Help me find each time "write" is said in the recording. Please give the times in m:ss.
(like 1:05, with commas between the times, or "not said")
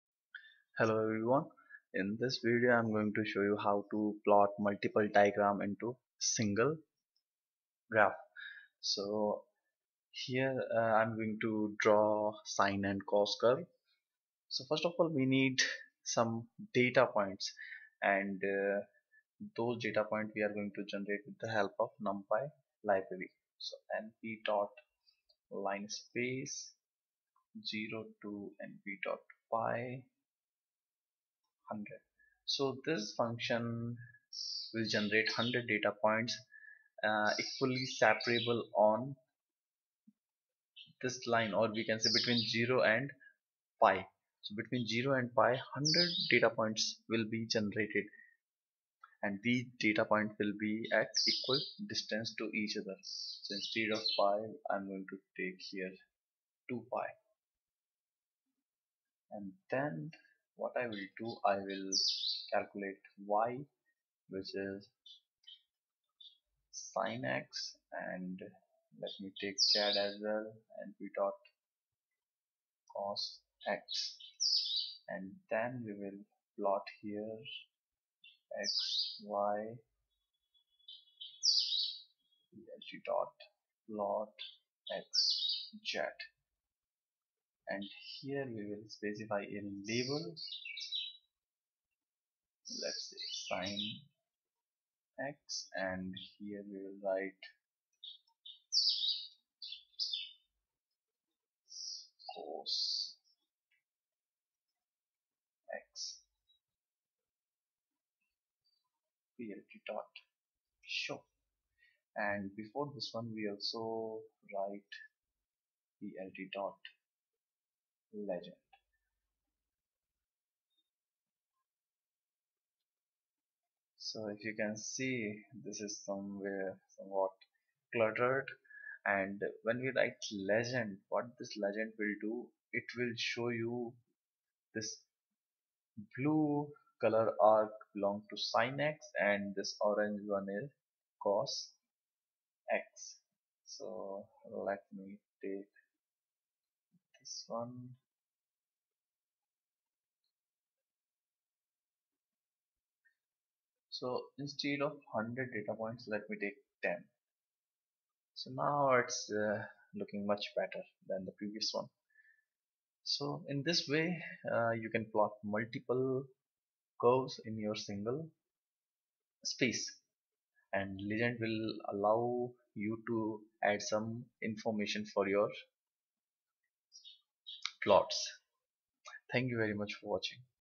1:37, 1:54, 2:09.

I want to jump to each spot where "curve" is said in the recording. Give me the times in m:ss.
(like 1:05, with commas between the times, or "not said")
0:13, 2:47.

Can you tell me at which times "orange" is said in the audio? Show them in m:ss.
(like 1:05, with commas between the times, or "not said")
2:19.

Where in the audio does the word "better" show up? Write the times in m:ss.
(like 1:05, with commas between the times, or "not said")
2:40.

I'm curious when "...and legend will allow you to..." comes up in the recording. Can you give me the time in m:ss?
2:50.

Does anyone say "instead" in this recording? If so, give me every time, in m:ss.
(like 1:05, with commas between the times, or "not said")
0:53, 2:34.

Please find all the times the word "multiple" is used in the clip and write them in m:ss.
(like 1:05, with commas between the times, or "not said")
0:04, 2:45.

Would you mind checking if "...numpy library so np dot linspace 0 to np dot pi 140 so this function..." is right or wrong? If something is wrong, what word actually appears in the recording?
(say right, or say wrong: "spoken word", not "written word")
wrong: "100", not "140".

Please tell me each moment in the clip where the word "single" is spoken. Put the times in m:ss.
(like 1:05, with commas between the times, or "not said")
0:06, 2:47.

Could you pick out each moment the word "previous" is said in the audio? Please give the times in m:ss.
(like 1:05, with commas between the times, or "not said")
2:41.